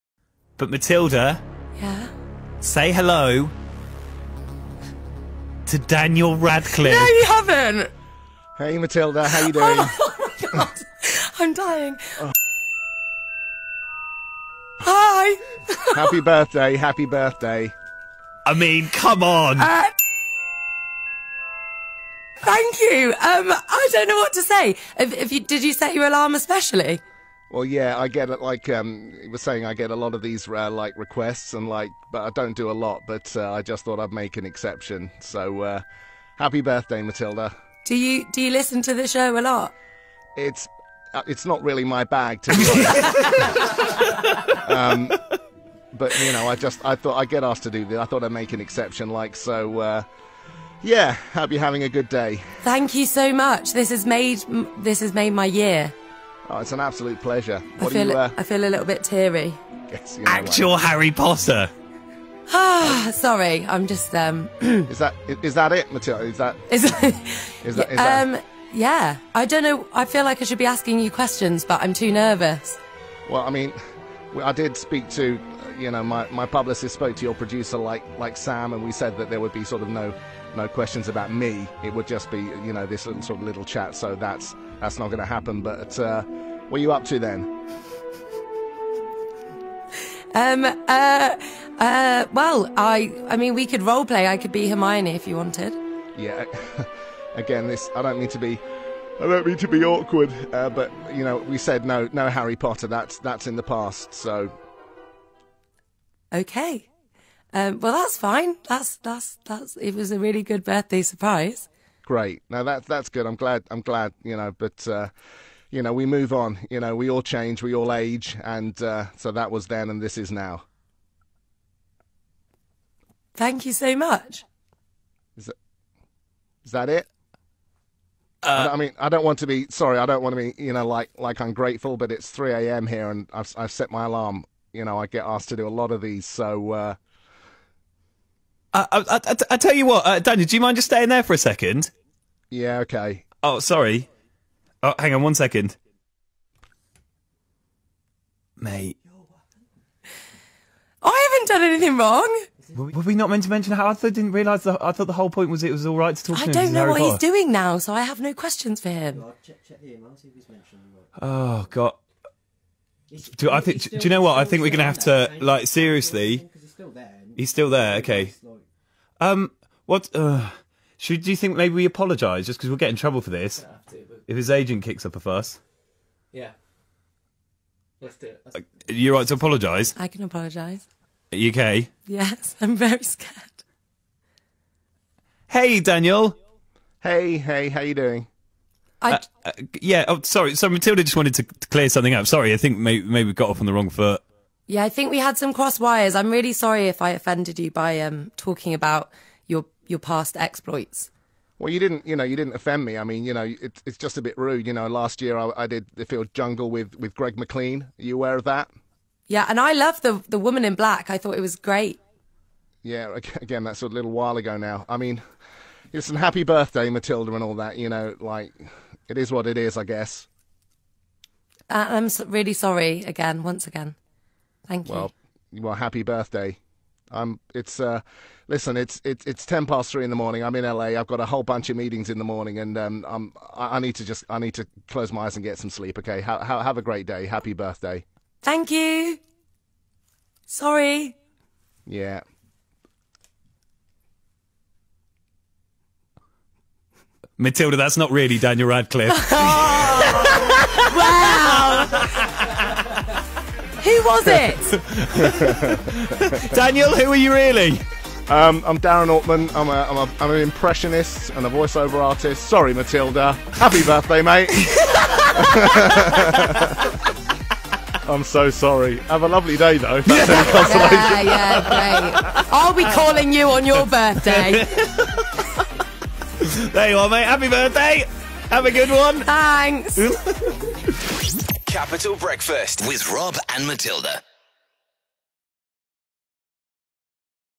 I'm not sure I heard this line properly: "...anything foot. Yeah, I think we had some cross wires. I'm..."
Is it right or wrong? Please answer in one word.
wrong.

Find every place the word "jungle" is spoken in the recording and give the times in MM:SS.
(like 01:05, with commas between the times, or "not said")
03:26.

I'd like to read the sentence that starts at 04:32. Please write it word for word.
I'll be calling you on your birthday.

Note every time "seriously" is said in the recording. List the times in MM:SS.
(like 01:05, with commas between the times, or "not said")
02:45.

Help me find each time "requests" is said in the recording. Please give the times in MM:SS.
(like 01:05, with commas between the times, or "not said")
00:30.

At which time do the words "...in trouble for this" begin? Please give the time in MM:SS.
02:52.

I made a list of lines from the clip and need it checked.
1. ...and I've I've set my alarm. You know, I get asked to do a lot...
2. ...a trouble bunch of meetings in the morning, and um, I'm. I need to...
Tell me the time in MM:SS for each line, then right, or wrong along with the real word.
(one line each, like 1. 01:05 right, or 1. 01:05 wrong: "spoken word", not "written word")
1. 02:13 right
2. 03:51 wrong: "whole", not "trouble".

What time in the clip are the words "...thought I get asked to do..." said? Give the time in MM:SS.
00:46.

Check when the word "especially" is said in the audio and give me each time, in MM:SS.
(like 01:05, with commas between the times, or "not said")
00:26.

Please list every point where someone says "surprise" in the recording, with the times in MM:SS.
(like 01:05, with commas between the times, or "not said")
01:51.